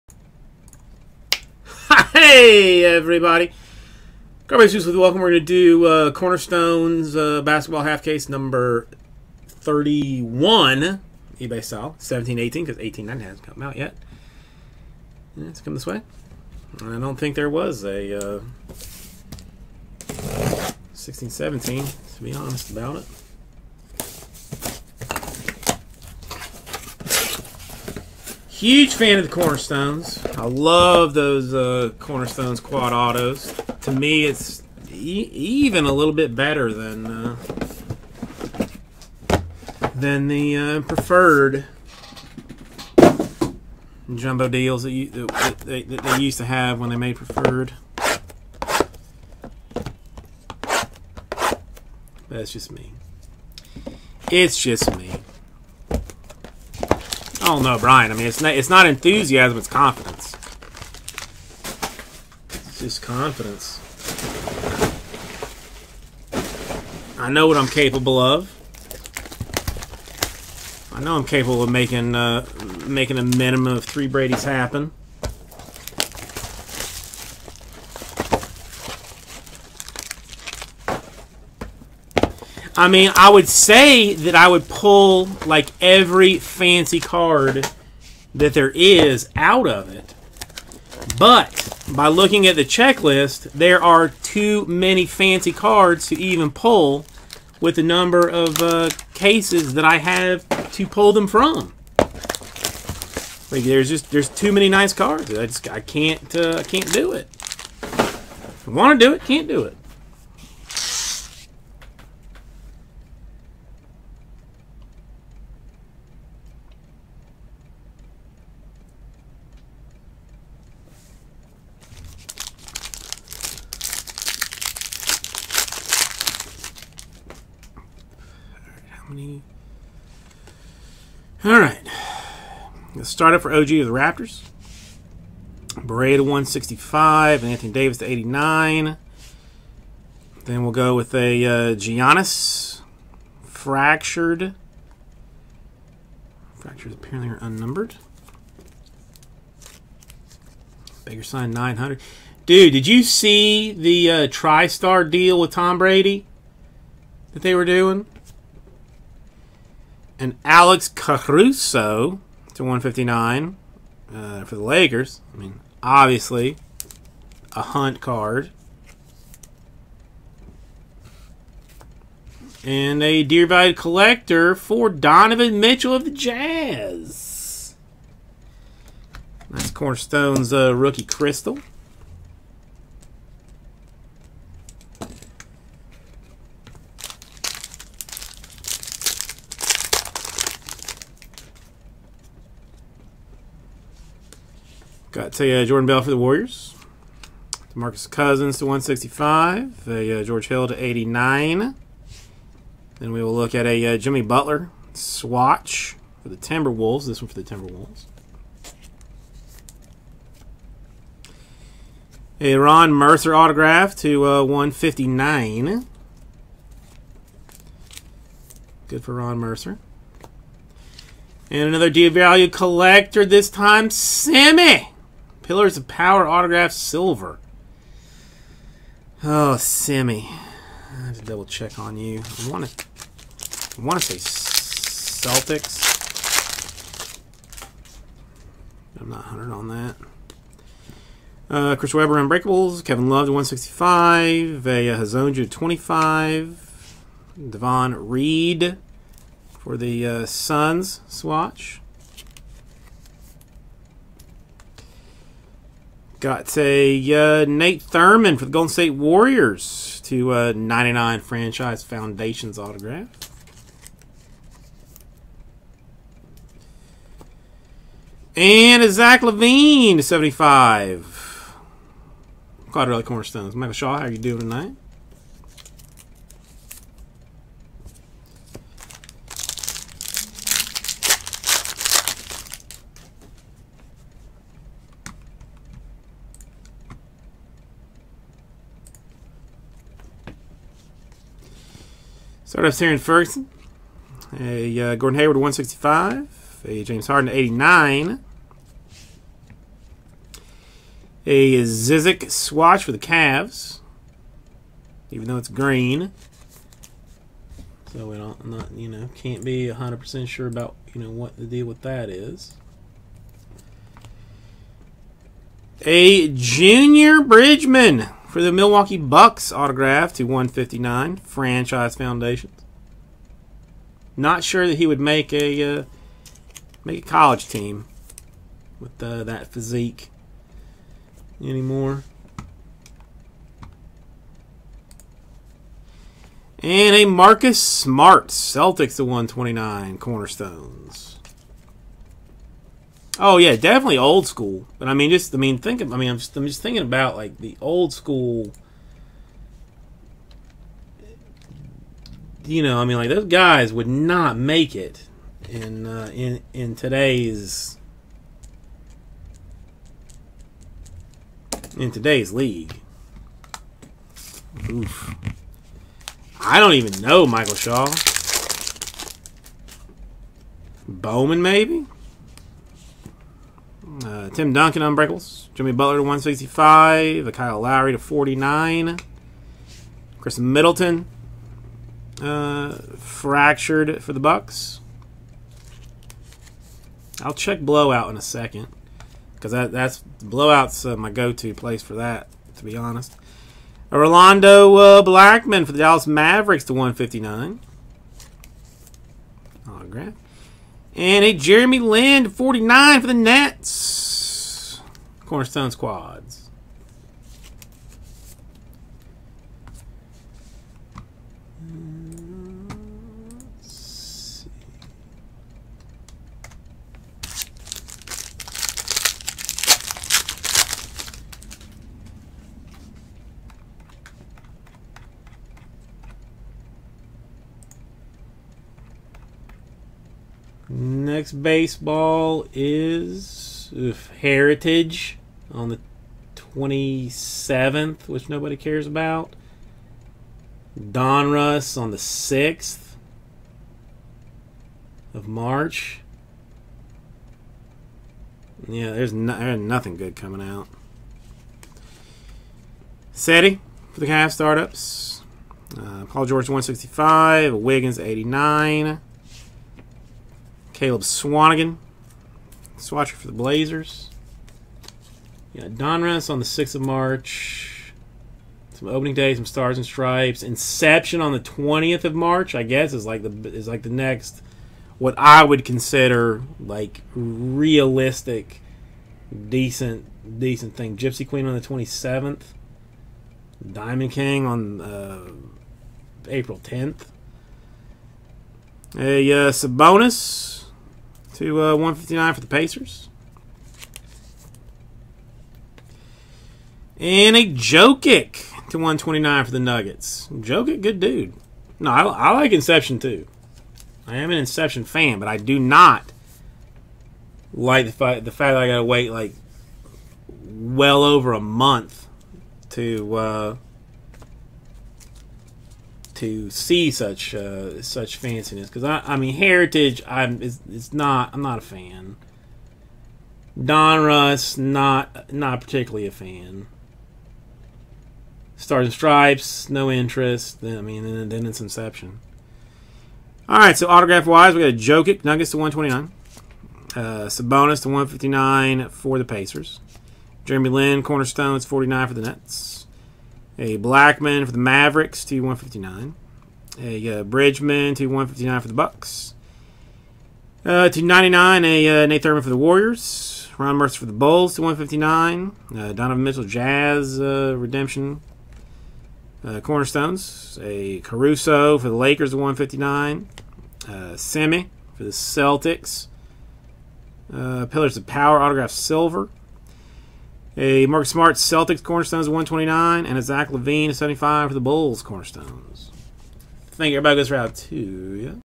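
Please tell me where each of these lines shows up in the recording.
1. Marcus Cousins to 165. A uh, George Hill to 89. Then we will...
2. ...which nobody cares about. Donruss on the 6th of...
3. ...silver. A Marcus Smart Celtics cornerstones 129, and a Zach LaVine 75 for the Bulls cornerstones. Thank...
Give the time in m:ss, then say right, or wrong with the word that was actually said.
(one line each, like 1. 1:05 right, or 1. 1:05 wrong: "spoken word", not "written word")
1. 3:17 right
2. 7:18 right
3. 9:28 right.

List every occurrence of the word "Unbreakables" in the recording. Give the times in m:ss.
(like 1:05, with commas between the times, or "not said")
4:02, 6:14.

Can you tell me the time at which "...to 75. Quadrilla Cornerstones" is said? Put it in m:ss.
4:29.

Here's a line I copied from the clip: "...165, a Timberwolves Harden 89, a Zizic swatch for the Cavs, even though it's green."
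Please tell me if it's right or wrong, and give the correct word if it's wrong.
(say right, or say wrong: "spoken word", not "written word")
wrong: "James", not "Timberwolves".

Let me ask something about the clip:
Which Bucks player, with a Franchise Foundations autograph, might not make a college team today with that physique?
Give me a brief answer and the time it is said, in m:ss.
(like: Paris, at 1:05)
Junior Bridgeman, at 5:16.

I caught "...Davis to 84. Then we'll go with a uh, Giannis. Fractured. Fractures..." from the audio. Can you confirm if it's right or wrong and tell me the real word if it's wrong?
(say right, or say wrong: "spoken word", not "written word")
wrong: "89", not "84".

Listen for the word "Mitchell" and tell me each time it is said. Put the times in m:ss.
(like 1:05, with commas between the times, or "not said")
2:55, 9:16.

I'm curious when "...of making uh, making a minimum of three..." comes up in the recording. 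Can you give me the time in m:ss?
1:11.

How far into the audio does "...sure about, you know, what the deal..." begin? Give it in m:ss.
5:10.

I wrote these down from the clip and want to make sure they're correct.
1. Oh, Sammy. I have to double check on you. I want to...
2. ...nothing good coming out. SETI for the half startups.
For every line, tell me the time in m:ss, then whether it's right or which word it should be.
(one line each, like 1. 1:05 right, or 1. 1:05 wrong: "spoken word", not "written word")
1. 3:49 right
2. 7:29 right.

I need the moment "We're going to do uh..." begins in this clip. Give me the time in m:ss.
0:05.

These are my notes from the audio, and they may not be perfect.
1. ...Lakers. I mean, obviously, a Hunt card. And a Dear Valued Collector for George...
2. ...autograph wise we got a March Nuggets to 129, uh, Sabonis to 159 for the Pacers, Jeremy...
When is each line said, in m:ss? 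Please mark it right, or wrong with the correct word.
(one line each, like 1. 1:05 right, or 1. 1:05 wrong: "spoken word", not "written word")
1. 2:44 wrong: "Donovan", not "George"
2. 8:53 wrong: "Jokic", not "March".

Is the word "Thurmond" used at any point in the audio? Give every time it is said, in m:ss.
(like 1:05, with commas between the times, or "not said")
4:17, 9:12.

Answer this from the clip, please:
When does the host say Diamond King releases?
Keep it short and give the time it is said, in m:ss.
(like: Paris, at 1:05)
April 10, at 8:06.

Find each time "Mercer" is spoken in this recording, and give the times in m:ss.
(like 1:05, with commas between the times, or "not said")
3:32, 3:39, 9:13.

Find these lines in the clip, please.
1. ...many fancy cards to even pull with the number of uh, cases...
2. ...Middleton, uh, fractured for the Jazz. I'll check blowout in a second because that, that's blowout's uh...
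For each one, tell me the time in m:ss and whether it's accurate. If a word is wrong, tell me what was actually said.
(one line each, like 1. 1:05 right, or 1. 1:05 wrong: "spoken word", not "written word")
1. 1:34 right
2. 6:20 wrong: "Bucks", not "Jazz".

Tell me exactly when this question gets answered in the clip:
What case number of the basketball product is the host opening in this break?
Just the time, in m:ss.
0:09.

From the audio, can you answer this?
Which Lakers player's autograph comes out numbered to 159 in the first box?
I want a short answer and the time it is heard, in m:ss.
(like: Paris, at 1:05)
Alex Caruso, at 2:40.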